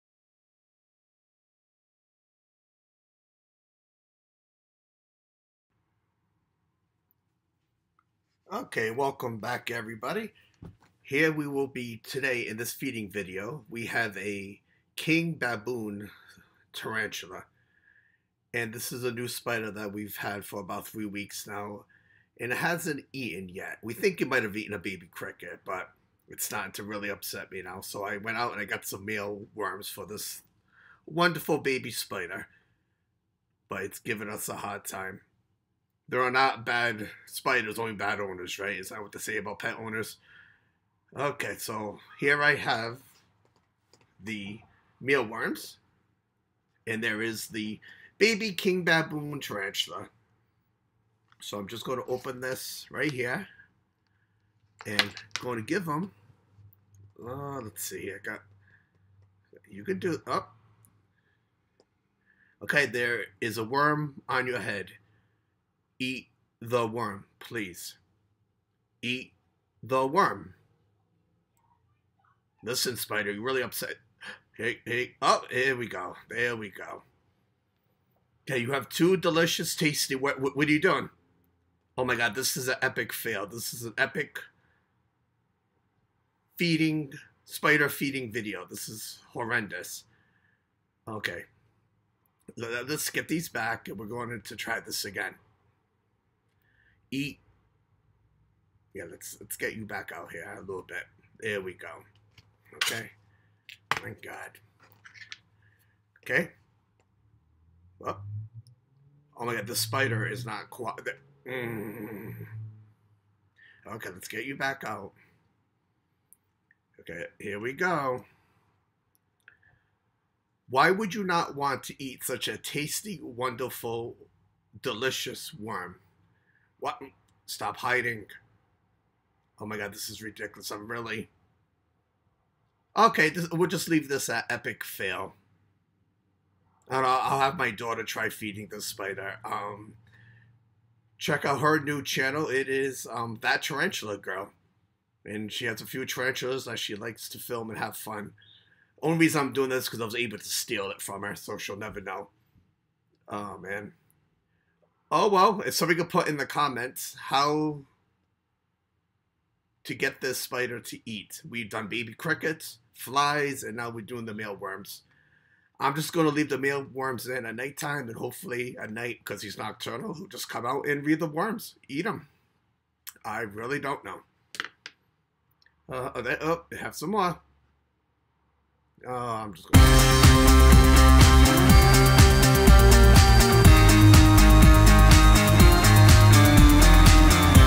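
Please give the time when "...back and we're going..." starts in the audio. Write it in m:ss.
1:33.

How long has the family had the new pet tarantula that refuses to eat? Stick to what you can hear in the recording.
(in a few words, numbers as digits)
About 3 weeks.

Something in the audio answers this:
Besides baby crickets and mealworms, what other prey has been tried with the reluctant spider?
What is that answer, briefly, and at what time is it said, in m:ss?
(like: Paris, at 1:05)
Flies, at 2:42.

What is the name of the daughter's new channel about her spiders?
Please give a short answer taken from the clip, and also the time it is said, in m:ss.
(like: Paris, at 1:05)
That Tarantula Girl, at 2:23.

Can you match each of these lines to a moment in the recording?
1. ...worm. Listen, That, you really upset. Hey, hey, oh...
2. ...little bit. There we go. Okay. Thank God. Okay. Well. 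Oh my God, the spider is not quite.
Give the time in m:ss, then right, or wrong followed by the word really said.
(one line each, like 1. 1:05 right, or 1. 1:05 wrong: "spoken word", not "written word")
1. 1:10 wrong: "Spider", not "That"
2. 1:40 right.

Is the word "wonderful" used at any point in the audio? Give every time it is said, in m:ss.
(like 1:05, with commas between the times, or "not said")
0:31, 2:03.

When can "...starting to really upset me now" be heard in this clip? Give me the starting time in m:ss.
0:26.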